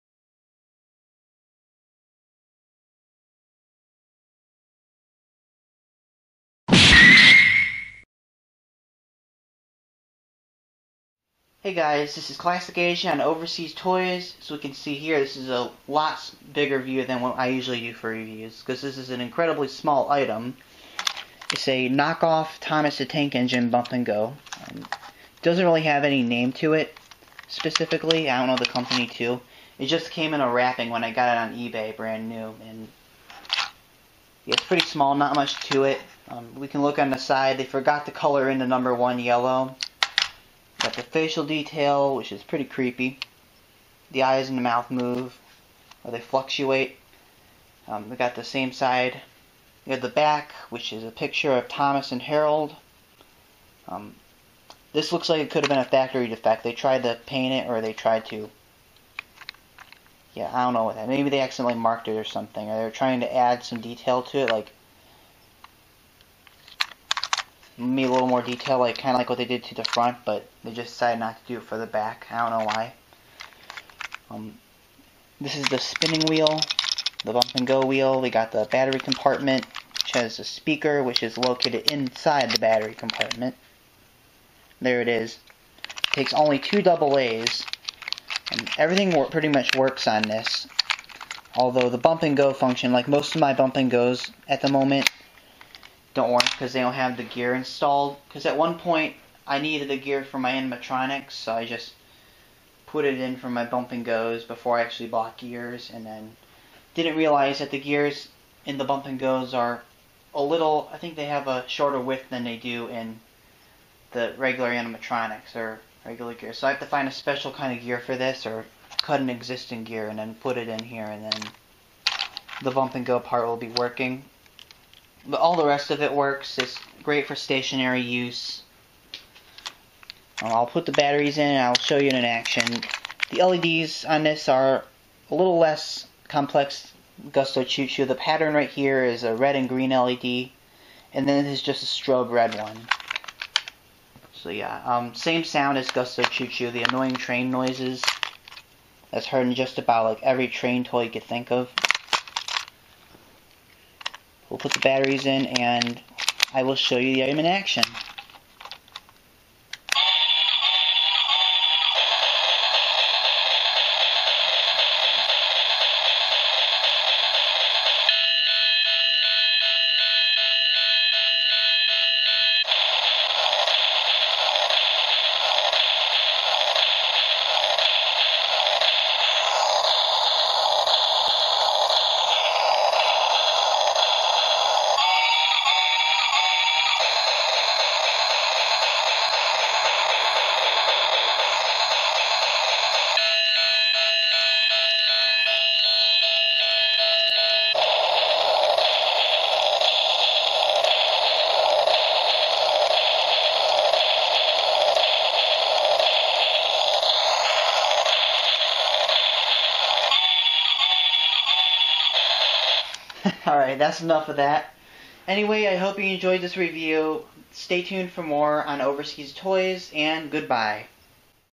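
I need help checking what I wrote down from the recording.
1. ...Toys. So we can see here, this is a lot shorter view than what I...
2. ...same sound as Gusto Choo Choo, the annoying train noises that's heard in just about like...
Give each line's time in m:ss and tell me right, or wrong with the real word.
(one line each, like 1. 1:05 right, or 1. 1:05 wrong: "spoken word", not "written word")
1. 0:13 wrong: "bigger", not "shorter"
2. 2:25 right.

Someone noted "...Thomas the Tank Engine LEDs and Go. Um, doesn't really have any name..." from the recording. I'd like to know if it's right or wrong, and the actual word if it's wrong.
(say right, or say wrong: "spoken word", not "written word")
wrong: "Bump", not "LEDs".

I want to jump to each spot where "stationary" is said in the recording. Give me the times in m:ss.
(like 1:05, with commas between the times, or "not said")
2:07.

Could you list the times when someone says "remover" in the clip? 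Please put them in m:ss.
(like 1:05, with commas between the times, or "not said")
not said.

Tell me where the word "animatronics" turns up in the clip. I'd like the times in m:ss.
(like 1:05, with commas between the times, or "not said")
1:40, 1:54.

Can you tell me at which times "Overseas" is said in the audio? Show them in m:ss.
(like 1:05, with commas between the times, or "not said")
0:13, 3:38.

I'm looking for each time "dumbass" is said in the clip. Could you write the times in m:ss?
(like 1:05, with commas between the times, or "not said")
not said.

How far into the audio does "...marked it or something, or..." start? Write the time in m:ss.
1:01.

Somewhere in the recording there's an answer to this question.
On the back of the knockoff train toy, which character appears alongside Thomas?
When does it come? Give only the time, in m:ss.
0:52.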